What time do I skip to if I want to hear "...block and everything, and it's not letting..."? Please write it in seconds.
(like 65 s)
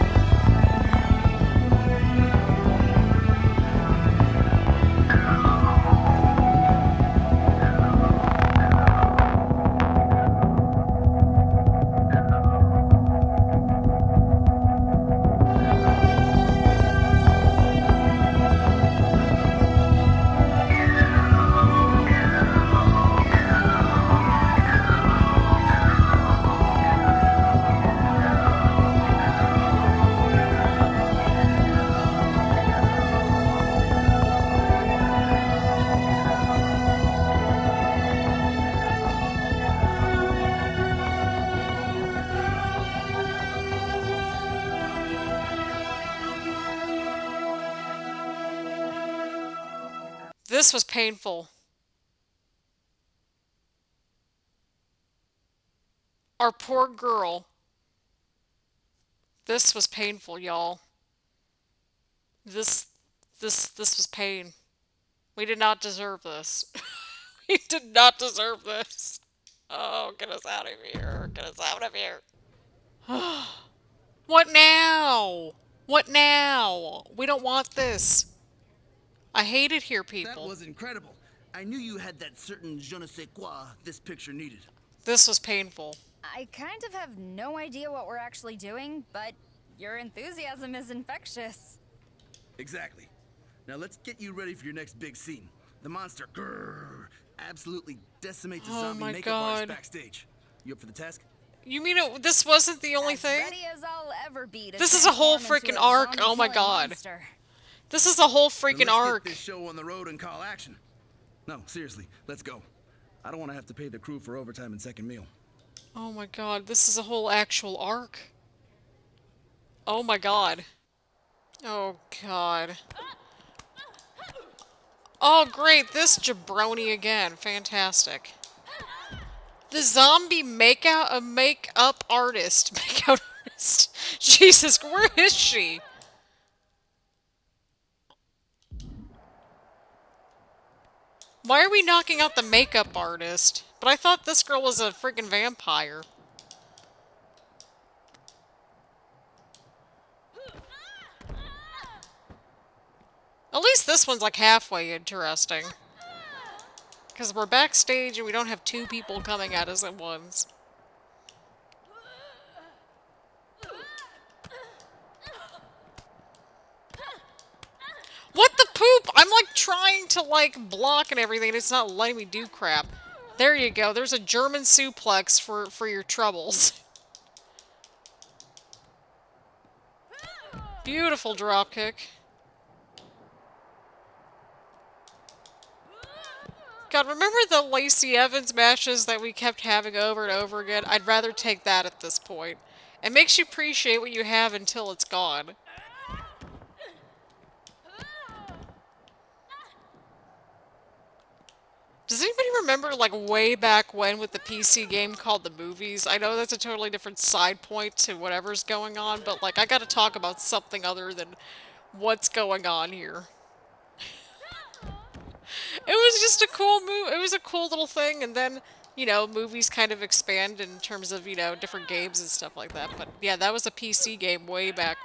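170 s.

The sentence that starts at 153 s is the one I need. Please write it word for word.
At least this one's like halfway interesting.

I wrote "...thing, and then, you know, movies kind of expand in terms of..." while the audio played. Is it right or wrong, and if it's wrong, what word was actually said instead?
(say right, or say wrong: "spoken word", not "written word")
right.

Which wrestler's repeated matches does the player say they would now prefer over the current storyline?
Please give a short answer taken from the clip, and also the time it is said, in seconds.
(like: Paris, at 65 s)
Lacey Evans, at 187 s.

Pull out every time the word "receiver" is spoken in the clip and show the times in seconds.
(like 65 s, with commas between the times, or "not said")
not said.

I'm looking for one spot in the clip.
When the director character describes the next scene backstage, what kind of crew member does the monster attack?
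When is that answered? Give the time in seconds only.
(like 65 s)
98 s.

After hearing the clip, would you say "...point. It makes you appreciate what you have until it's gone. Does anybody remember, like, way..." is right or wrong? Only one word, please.
right.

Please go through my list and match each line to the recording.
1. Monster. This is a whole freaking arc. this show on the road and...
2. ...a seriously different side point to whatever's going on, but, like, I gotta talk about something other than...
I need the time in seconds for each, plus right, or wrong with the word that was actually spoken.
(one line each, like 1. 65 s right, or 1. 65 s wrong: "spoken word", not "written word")
1. 106 s right
2. 206 s wrong: "totally", not "seriously".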